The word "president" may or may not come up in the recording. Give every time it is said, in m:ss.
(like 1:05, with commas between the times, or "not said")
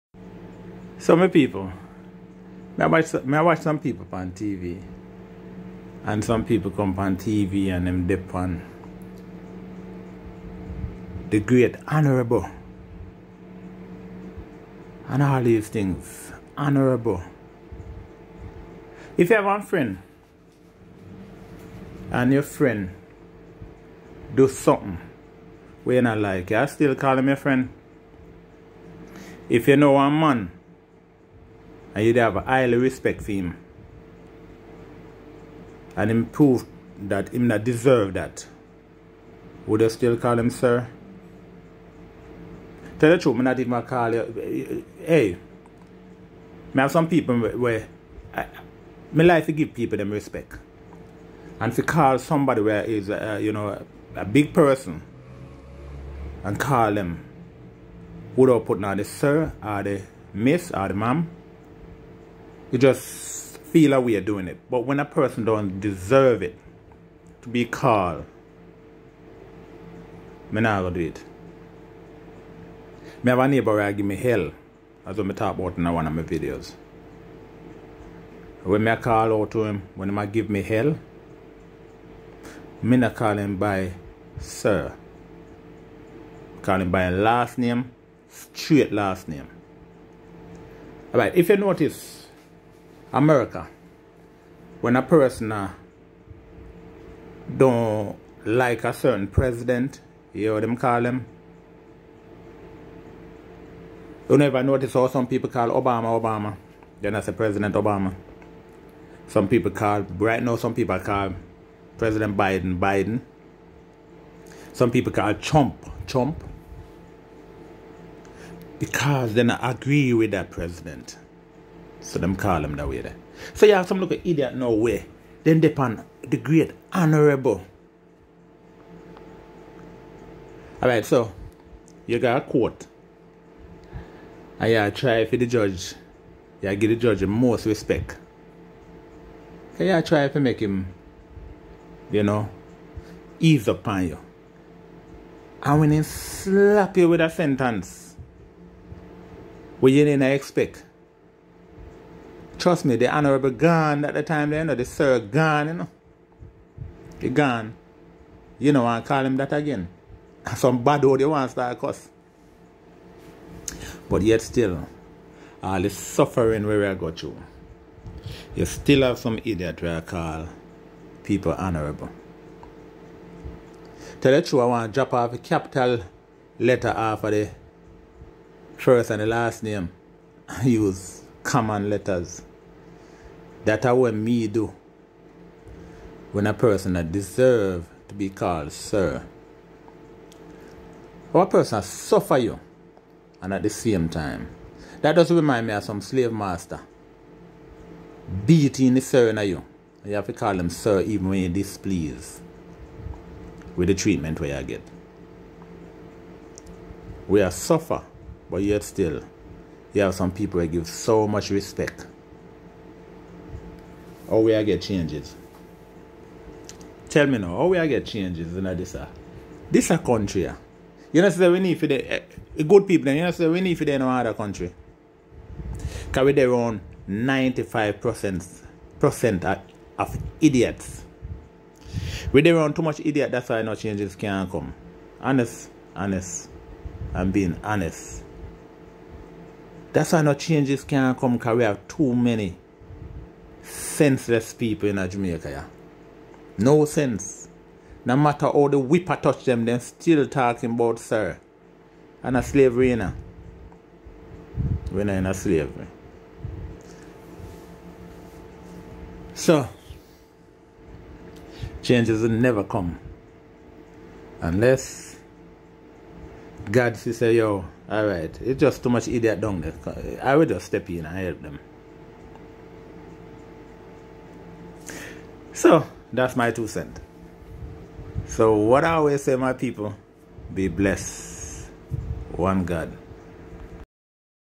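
1:39, 1:47, 1:51, 2:00.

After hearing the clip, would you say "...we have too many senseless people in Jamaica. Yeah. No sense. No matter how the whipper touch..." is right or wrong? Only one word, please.
right.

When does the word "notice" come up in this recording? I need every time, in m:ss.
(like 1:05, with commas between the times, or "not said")
1:31, 1:44.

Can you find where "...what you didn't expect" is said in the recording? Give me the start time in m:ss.
2:29.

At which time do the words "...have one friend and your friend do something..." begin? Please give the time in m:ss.
0:19.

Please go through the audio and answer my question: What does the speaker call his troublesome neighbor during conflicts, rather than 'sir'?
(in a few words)
Straight last name.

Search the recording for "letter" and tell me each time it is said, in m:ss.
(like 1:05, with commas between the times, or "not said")
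2:56, 3:01.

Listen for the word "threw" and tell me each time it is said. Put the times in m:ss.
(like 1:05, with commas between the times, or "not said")
not said.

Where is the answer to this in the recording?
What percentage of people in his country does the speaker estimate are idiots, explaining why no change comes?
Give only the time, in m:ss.
3:47.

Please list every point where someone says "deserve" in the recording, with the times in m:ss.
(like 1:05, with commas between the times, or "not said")
0:37, 1:05, 3:07.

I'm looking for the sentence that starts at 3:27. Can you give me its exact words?
We are suffer, but yet still, you have some people that give so much respect all oh, way I get changes.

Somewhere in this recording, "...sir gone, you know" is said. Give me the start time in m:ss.
2:34.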